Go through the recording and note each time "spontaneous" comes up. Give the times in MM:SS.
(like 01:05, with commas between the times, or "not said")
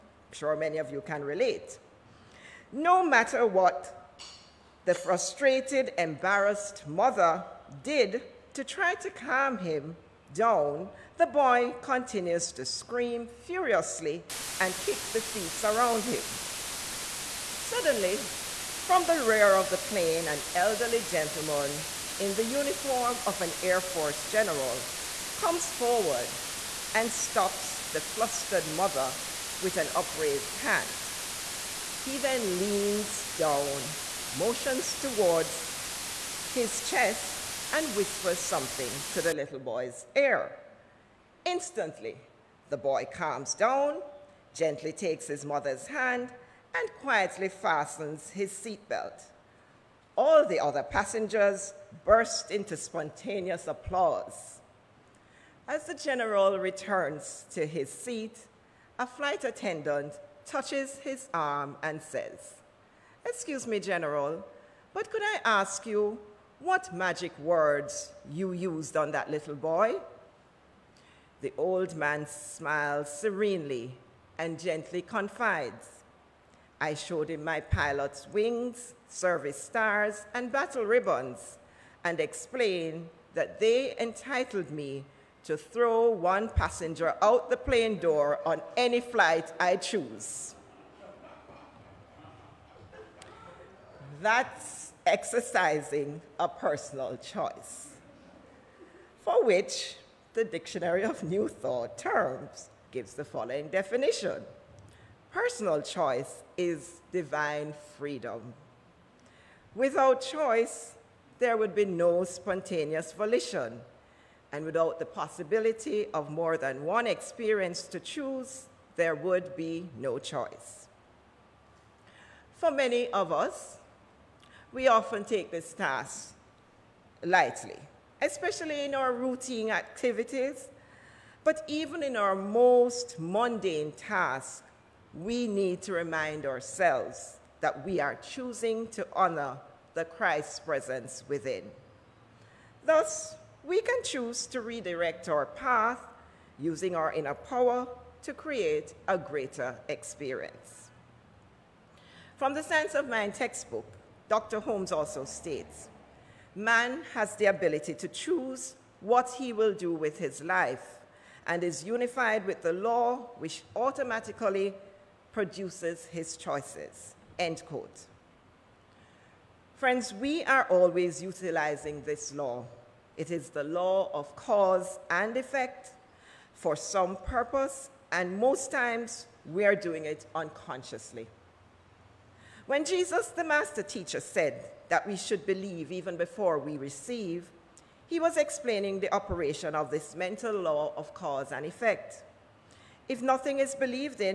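00:52, 01:52.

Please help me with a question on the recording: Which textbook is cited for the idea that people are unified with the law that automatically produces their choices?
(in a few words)
Science of Mind.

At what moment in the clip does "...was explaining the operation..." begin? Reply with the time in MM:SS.
03:08.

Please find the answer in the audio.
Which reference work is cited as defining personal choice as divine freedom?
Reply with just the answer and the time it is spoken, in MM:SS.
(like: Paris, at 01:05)
Dictionary of New Thought Terms, at 01:40.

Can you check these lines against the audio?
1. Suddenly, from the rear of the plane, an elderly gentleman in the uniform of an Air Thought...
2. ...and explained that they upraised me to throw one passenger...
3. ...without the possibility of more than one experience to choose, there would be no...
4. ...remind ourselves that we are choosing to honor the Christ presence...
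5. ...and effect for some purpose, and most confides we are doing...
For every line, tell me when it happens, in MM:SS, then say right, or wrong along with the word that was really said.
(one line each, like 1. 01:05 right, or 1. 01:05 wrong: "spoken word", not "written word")
1. 00:17 wrong: "Force", not "Thought"
2. 01:22 wrong: "entitled", not "upraised"
3. 01:54 right
4. 02:15 right
5. 02:55 wrong: "times", not "confides".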